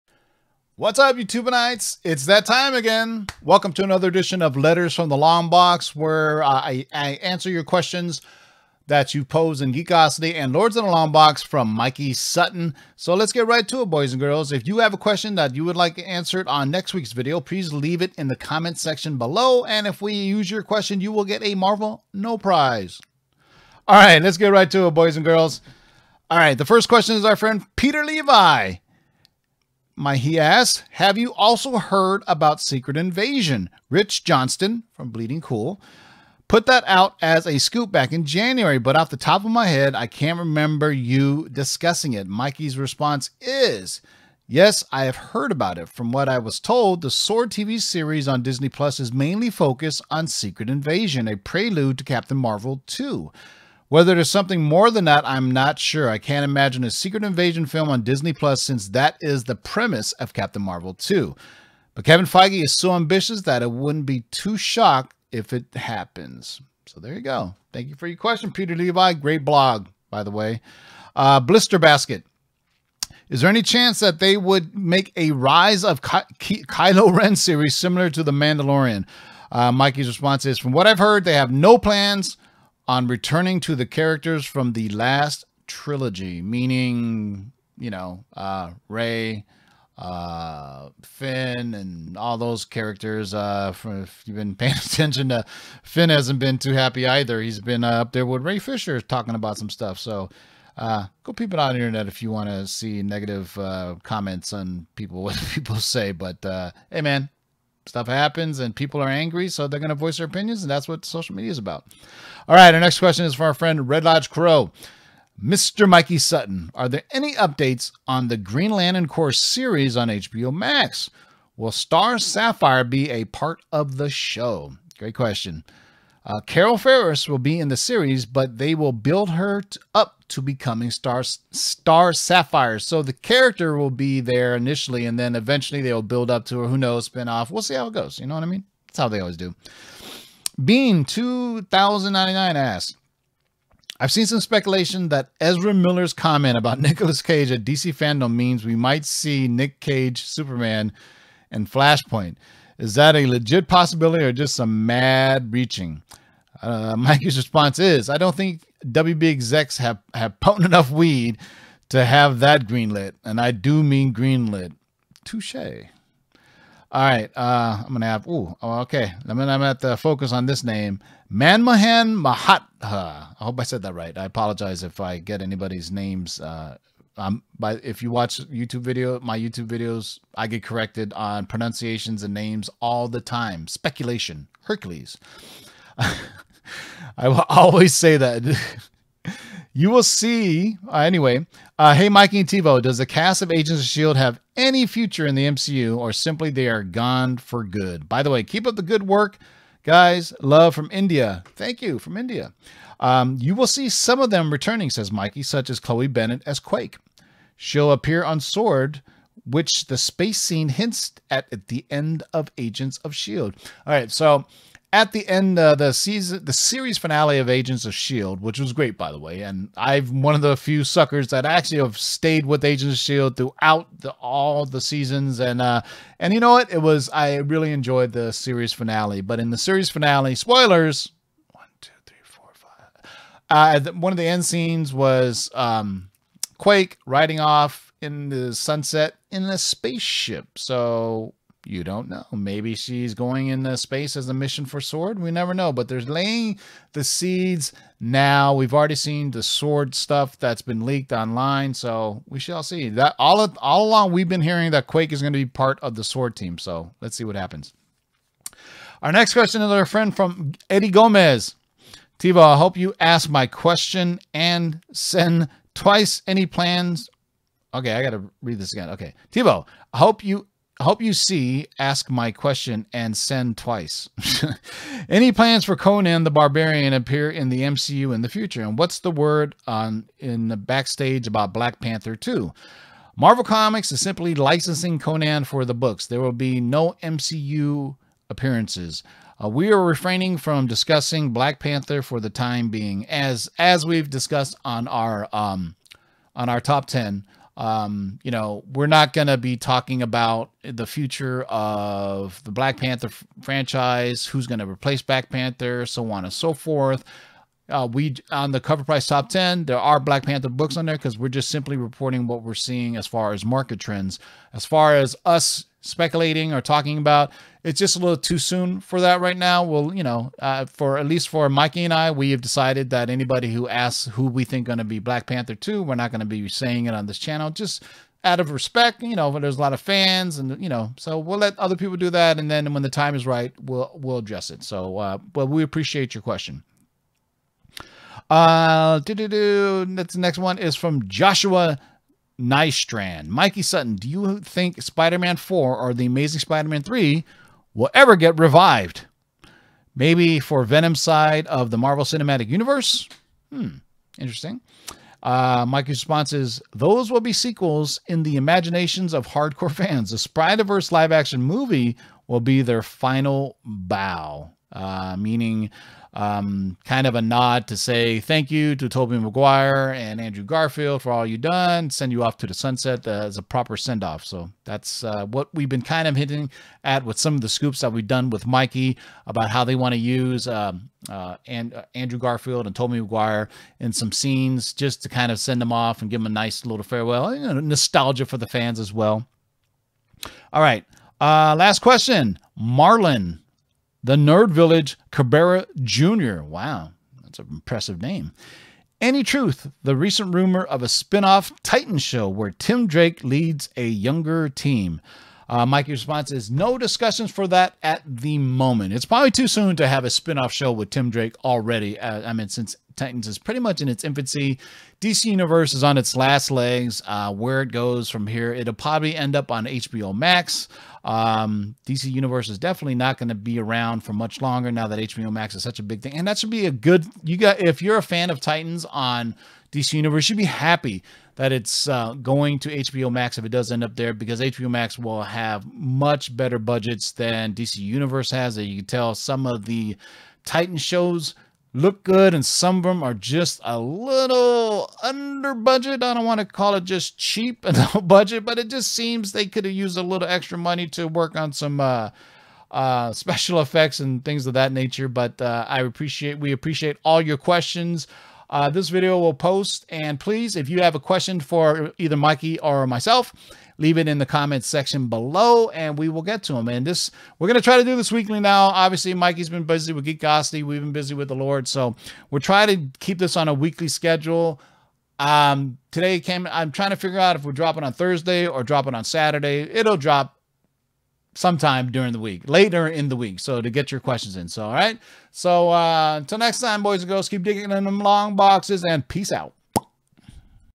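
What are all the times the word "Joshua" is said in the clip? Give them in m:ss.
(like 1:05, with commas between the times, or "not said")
5:41.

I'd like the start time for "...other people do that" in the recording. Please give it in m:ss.
5:31.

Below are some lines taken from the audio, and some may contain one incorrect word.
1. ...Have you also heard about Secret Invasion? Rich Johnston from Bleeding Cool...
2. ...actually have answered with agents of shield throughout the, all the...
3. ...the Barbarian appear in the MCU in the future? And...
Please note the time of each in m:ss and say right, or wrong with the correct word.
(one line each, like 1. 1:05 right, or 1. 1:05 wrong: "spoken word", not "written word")
1. 0:30 right
2. 3:41 wrong: "stayed", not "answered"
3. 4:36 right.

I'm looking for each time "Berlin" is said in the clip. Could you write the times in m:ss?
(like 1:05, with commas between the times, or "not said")
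not said.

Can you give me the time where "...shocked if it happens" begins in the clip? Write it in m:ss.
1:04.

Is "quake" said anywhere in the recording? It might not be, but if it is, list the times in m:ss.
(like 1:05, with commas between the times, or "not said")
3:26, 3:56, 4:14.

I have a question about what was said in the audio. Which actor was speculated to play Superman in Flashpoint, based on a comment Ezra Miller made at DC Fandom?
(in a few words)
Nicolas Cage.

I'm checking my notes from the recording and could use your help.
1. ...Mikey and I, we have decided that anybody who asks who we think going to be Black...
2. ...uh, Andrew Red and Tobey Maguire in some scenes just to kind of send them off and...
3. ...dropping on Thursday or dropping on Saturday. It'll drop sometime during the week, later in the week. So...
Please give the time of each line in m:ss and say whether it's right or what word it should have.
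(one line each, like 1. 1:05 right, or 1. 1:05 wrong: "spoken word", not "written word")
1. 5:21 right
2. 6:21 wrong: "Garfield", not "Red"
3. 7:57 right.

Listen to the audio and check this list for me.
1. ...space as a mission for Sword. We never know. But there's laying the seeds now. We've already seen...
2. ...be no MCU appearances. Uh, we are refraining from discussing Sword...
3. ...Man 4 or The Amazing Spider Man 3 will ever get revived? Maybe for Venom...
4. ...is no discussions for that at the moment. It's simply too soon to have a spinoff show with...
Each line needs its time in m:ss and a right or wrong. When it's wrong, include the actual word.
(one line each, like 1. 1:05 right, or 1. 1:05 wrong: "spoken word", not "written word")
1. 4:03 right
2. 4:46 wrong: "Black", not "Sword"
3. 5:45 right
4. 6:46 wrong: "probably", not "simply".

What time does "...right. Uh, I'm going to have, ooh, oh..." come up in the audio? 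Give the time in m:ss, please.
2:47.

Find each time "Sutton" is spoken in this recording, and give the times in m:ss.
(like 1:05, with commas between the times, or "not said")
0:12, 1:56, 5:43.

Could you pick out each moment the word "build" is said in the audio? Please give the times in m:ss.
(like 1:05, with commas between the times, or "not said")
2:08, 2:16.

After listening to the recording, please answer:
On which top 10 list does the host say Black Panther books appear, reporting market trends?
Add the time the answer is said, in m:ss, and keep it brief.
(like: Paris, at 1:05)
CovrPrice top 10, at 5:08.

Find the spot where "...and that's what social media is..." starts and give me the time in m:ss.
1:50.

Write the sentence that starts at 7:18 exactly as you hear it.
As you can tell, some of the Titan shows look good and some of them are just a little under budget.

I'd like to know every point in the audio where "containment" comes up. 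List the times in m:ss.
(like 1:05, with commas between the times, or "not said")
not said.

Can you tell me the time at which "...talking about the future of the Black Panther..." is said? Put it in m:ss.
4:59.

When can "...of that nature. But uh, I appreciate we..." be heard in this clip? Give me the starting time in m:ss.
7:34.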